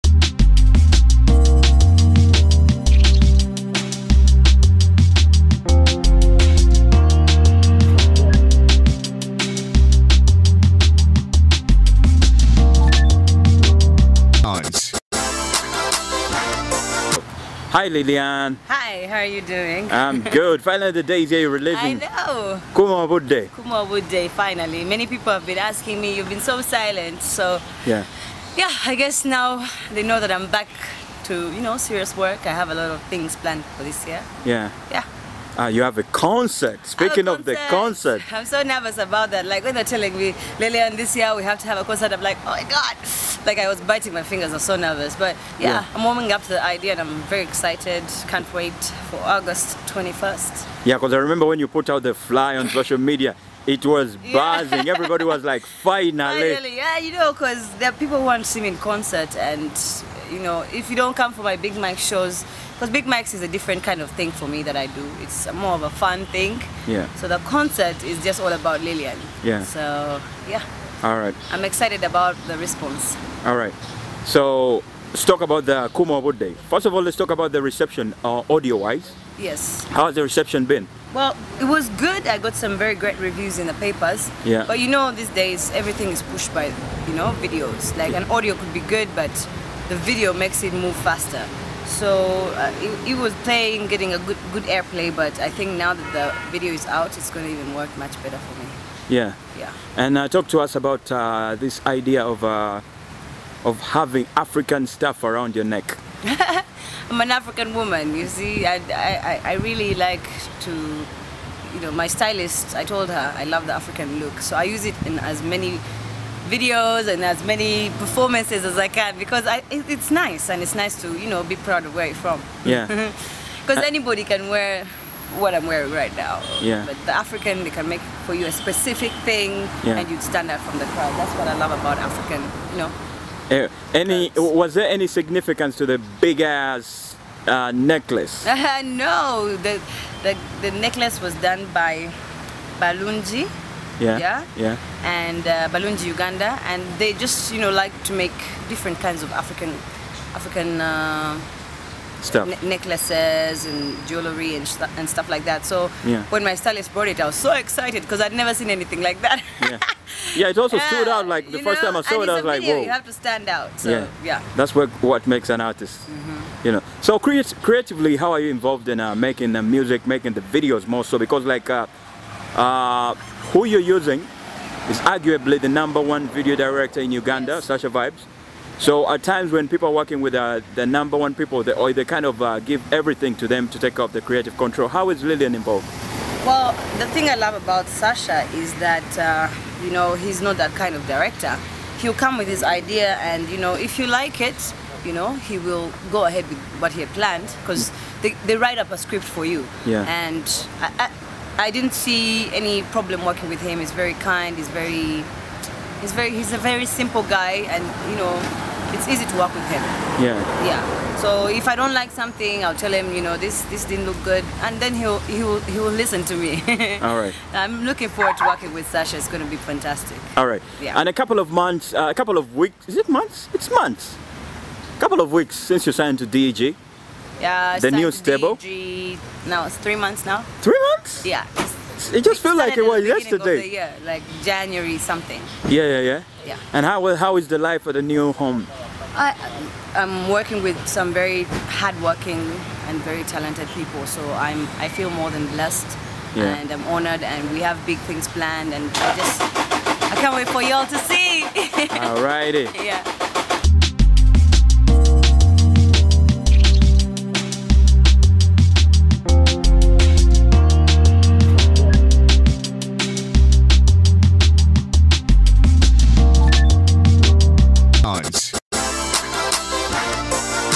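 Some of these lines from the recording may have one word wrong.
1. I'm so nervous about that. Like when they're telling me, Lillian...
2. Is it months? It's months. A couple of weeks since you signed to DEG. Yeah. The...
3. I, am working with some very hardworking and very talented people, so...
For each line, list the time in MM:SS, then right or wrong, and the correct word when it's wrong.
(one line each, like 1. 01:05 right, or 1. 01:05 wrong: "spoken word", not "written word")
1. 00:38 right
2. 03:42 right
3. 03:59 right.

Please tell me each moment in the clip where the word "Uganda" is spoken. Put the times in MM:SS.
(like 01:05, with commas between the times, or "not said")
02:26, 02:57.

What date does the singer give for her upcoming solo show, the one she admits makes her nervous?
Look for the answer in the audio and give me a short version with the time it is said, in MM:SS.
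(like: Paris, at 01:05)
August 21st, at 00:49.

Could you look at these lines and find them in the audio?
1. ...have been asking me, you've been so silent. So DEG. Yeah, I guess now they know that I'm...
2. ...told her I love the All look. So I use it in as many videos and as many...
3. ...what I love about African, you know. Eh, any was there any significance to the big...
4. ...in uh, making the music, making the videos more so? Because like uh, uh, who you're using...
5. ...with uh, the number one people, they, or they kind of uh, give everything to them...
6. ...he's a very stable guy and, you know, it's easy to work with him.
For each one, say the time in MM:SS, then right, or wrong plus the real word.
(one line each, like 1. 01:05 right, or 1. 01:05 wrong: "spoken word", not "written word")
1. 00:25 wrong: "Yeah", not "DEG"
2. 01:52 wrong: "African", not "All"
3. 02:11 right
4. 02:48 right
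5. 03:00 right
6. 03:26 wrong: "simple", not "stable".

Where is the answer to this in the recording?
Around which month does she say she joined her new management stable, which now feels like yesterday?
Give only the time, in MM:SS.
03:54.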